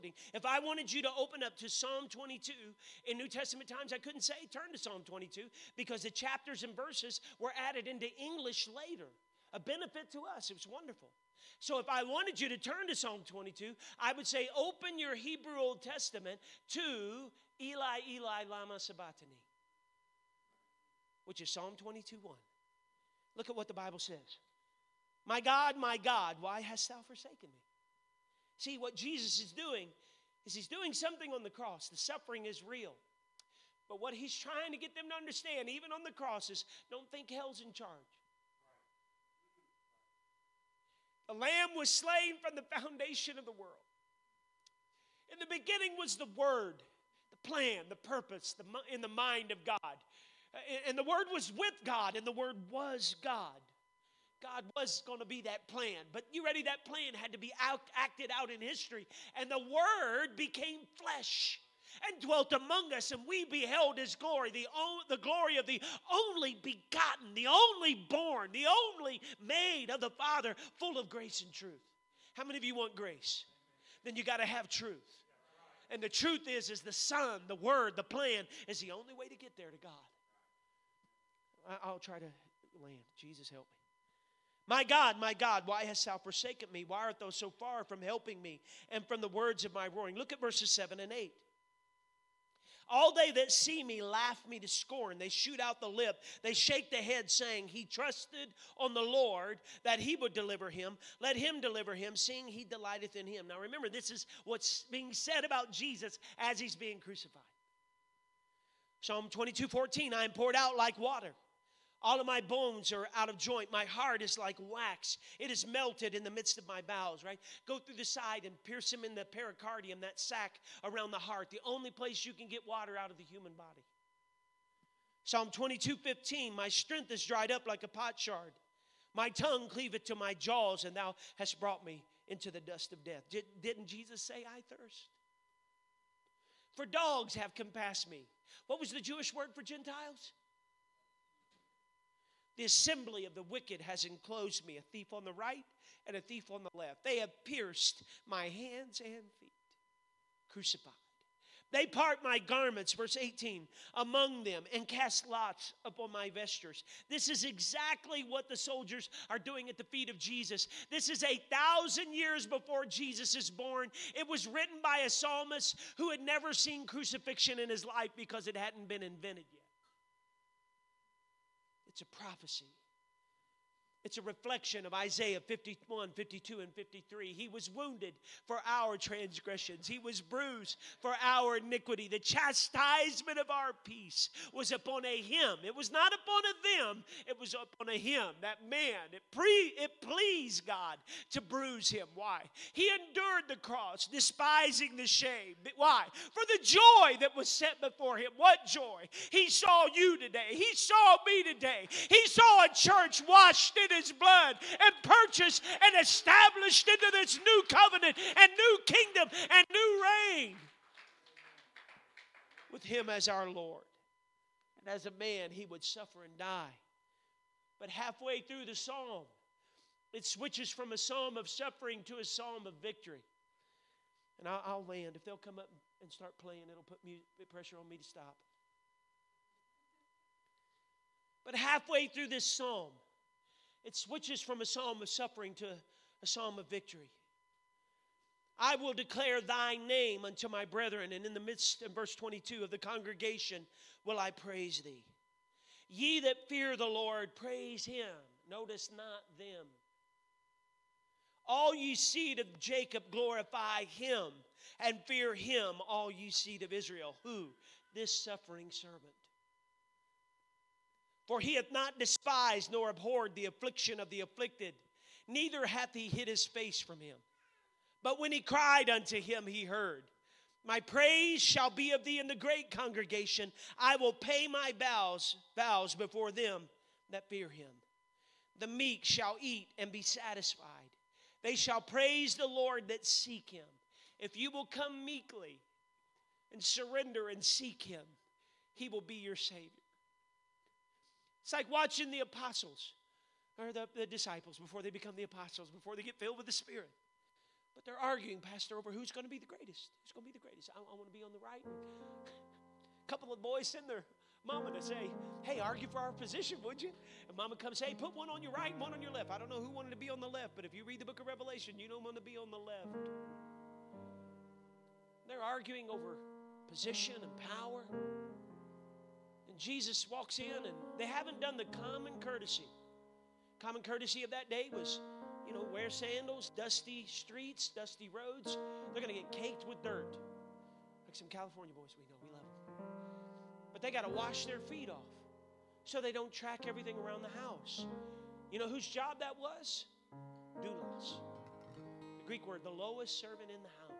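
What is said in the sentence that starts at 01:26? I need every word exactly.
Why art thou so far from helping me and from the words of my roaring?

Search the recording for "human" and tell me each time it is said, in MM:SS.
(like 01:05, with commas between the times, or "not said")
02:03.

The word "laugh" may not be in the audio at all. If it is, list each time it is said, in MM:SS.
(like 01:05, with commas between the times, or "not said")
01:34.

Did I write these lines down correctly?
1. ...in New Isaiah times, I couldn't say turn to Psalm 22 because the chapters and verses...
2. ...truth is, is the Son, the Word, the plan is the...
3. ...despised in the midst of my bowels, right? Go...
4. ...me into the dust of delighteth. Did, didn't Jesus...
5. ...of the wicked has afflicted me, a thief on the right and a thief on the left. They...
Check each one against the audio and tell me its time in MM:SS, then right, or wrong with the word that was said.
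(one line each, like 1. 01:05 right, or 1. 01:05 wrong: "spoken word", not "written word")
1. 00:03 wrong: "Testament", not "Isaiah"
2. 01:16 right
3. 01:55 wrong: "melted", not "despised"
4. 02:11 wrong: "death", not "delighteth"
5. 02:23 wrong: "enclosed", not "afflicted".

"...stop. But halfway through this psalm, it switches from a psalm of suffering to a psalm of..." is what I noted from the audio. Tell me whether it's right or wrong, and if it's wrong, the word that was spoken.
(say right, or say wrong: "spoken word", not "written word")
right.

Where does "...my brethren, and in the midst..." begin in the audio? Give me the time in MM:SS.
04:00.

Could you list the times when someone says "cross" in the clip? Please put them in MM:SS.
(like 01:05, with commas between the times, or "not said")
00:31, 00:36, 03:13.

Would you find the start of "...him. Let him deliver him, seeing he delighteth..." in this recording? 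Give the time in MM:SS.
01:40.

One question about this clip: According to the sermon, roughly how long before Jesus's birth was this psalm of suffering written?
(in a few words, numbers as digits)
a thousand years.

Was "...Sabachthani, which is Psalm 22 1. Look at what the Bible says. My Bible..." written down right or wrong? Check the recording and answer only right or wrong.
wrong.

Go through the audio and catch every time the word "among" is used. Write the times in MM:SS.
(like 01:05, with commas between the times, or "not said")
01:02, 02:33.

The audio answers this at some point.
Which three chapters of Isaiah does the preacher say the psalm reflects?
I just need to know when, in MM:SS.
02:54.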